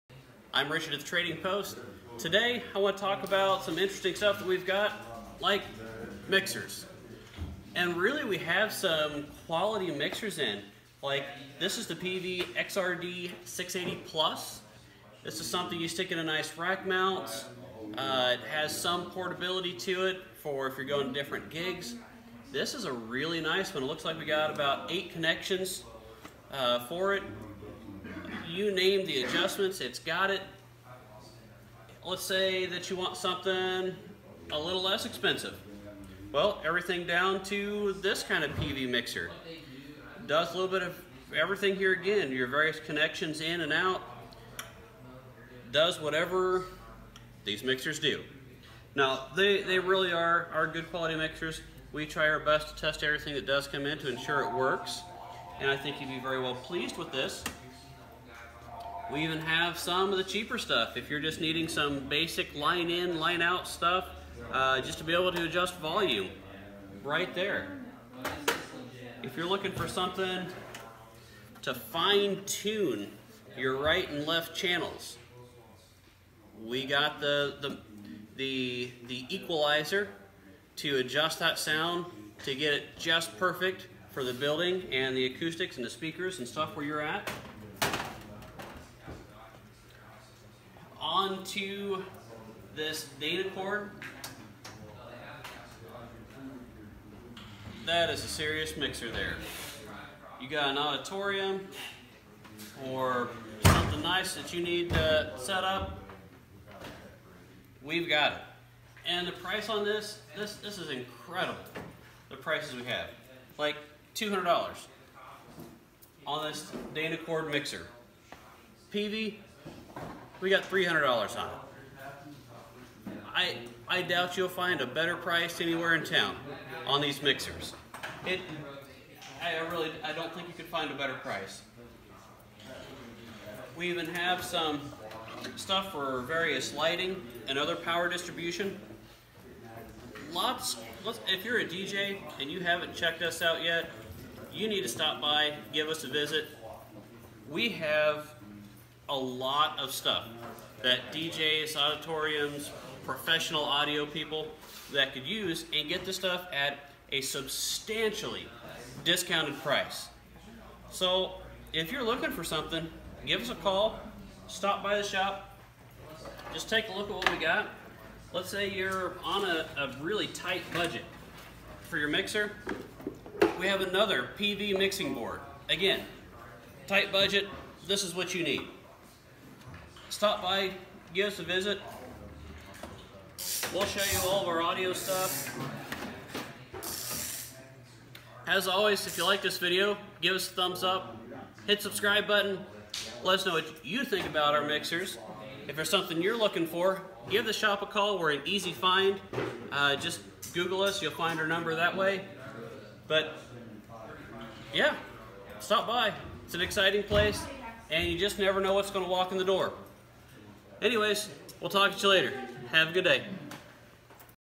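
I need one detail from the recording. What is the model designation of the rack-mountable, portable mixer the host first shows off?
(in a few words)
PV XRD 680 Plus.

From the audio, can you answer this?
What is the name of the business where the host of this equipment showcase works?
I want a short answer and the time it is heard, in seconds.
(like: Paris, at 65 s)
Trading Post, at 1 s.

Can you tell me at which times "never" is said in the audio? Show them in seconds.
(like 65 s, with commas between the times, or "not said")
208 s.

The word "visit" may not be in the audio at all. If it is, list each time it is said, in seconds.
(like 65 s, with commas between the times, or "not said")
146 s, 181 s.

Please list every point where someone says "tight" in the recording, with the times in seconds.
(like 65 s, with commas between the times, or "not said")
170 s, 176 s.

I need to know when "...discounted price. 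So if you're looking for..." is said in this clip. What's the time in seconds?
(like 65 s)
159 s.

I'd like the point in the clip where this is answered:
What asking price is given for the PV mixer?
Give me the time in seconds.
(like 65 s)
120 s.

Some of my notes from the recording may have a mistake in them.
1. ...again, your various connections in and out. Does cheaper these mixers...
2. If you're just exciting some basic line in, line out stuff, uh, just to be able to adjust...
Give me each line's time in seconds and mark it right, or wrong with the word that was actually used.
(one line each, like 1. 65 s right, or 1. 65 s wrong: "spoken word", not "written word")
1. 41 s wrong: "whatever", not "cheaper"
2. 60 s wrong: "needing", not "exciting".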